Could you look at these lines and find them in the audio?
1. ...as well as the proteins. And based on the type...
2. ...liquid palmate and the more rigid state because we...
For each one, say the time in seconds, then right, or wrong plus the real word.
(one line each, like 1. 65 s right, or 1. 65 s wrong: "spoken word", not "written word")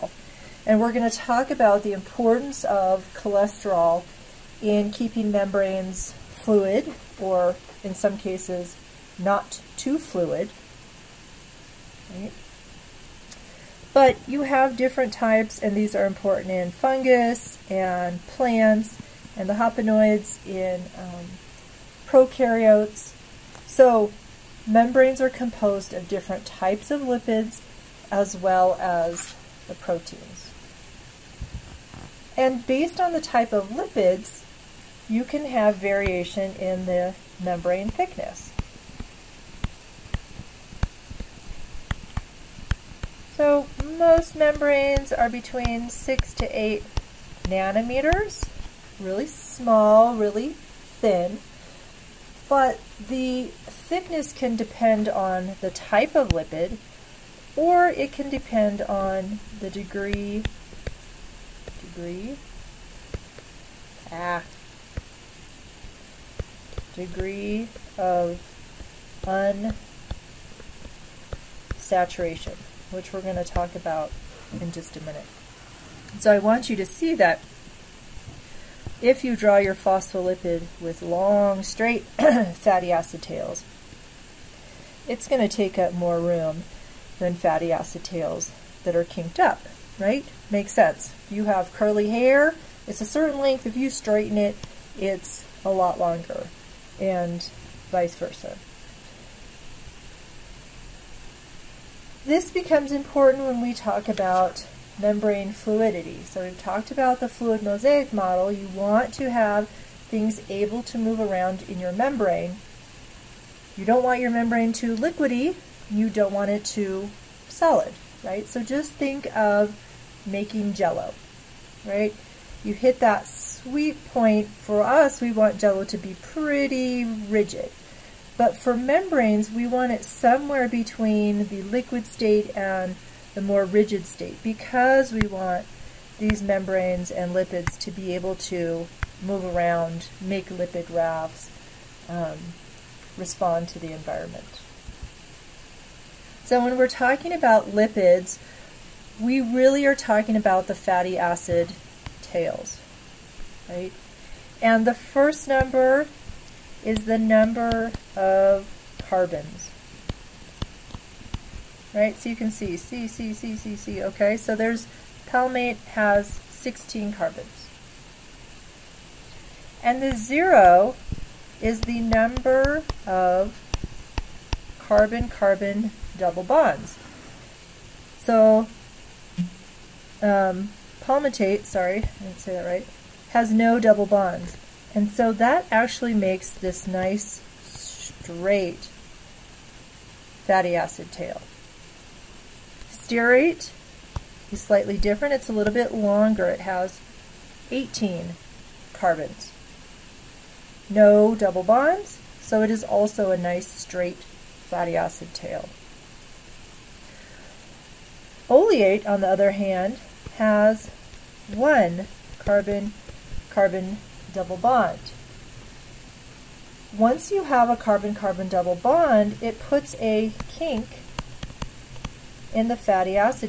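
1. 28 s right
2. 131 s wrong: "state", not "palmate".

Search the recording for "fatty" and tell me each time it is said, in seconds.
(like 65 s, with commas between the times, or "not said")
82 s, 87 s, 150 s, 190 s, 204 s, 222 s.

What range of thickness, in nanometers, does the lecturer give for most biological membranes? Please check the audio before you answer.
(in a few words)
6 to 8 nanometers.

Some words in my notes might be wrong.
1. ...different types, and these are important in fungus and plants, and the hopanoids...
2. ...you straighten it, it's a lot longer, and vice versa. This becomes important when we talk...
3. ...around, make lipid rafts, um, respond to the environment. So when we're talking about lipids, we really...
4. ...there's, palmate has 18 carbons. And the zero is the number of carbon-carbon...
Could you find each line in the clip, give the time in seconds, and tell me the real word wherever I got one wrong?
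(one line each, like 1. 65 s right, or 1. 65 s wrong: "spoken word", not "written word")
1. 14 s right
2. 93 s right
3. 139 s right
4. 164 s wrong: "16", not "18".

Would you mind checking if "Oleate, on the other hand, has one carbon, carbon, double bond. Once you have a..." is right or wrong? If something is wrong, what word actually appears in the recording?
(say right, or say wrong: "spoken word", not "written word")
right.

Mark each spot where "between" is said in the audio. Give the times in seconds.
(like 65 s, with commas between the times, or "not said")
45 s, 130 s.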